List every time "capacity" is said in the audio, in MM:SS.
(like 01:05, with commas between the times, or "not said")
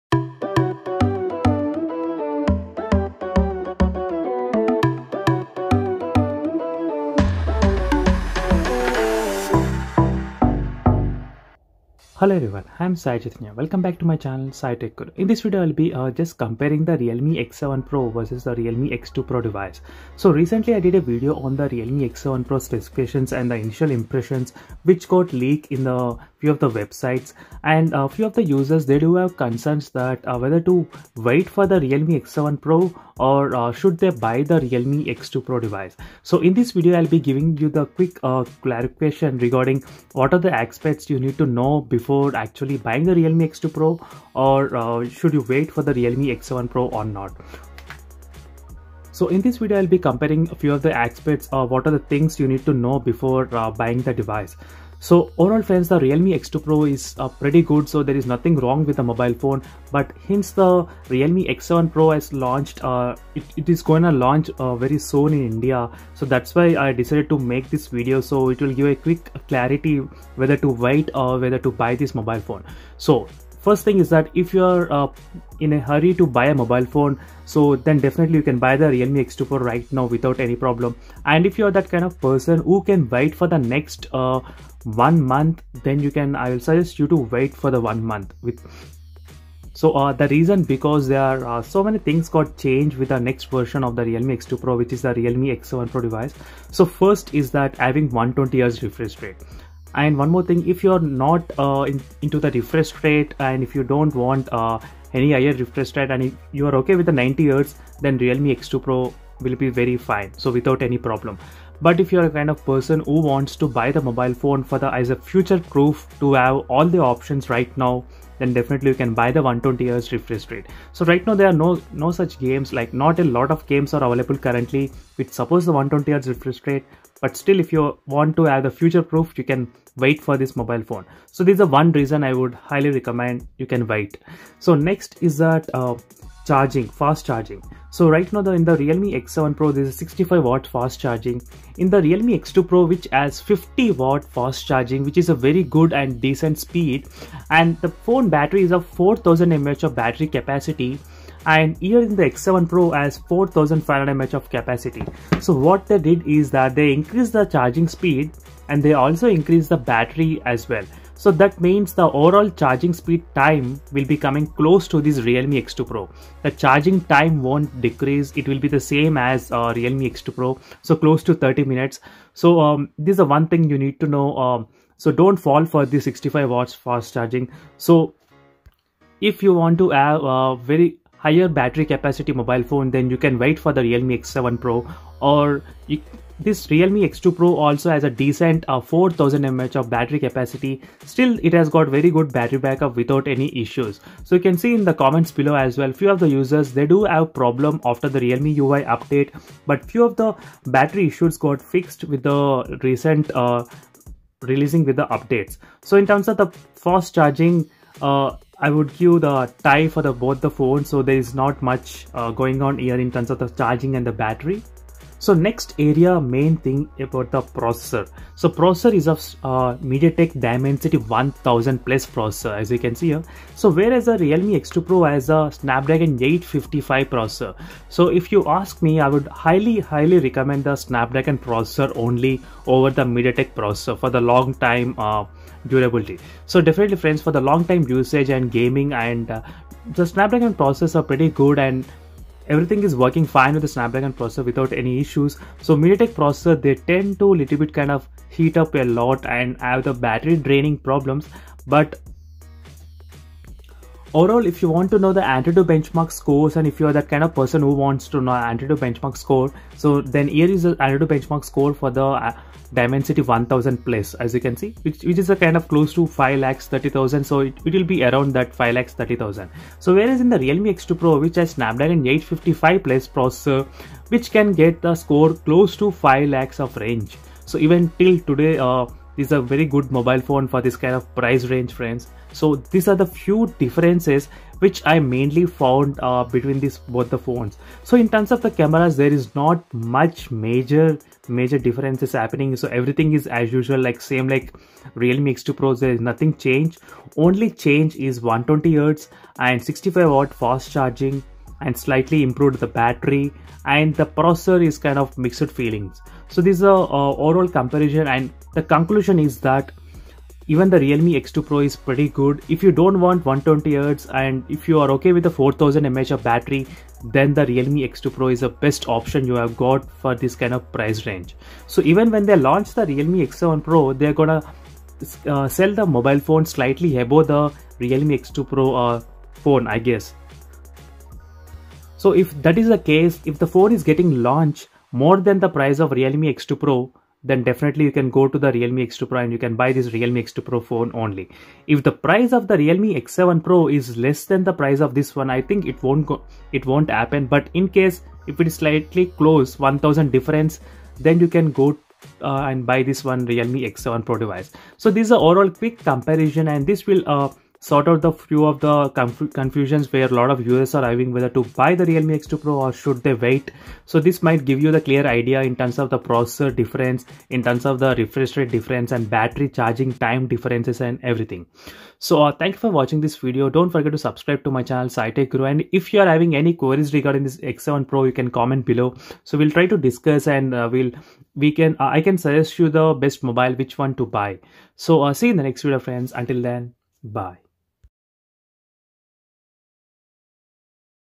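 02:30, 02:34, 03:01, 03:10.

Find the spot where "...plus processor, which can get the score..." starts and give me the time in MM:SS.
04:32.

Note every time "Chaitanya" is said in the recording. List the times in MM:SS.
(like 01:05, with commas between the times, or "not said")
00:13.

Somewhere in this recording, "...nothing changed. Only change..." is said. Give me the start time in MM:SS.
04:55.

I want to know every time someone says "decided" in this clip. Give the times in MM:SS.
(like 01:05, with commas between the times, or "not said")
01:06.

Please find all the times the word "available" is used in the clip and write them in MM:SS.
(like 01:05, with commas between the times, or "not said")
02:04.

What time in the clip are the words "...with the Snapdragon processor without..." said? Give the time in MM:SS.
04:03.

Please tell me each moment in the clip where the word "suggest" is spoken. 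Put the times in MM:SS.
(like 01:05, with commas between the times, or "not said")
01:26, 06:22.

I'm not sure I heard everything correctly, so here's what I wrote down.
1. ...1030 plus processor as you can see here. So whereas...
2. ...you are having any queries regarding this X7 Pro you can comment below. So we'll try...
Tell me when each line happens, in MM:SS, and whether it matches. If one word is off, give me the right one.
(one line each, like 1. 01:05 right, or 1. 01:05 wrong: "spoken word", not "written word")
1. 03:40 wrong: "1000", not "1030"
2. 06:15 right.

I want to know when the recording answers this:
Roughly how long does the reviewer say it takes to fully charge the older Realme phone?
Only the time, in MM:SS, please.
02:51.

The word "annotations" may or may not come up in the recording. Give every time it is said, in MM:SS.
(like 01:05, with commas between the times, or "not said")
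not said.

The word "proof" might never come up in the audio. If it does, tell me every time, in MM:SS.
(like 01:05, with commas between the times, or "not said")
01:55, 02:09.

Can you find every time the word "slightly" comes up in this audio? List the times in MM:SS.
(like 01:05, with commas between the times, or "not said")
05:01, 05:26, 05:48.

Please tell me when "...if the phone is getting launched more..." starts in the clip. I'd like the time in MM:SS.
05:33.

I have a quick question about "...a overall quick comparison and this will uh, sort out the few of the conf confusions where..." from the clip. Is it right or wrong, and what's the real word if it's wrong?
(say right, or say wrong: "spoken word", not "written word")
right.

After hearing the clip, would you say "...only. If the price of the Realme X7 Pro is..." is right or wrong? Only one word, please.
right.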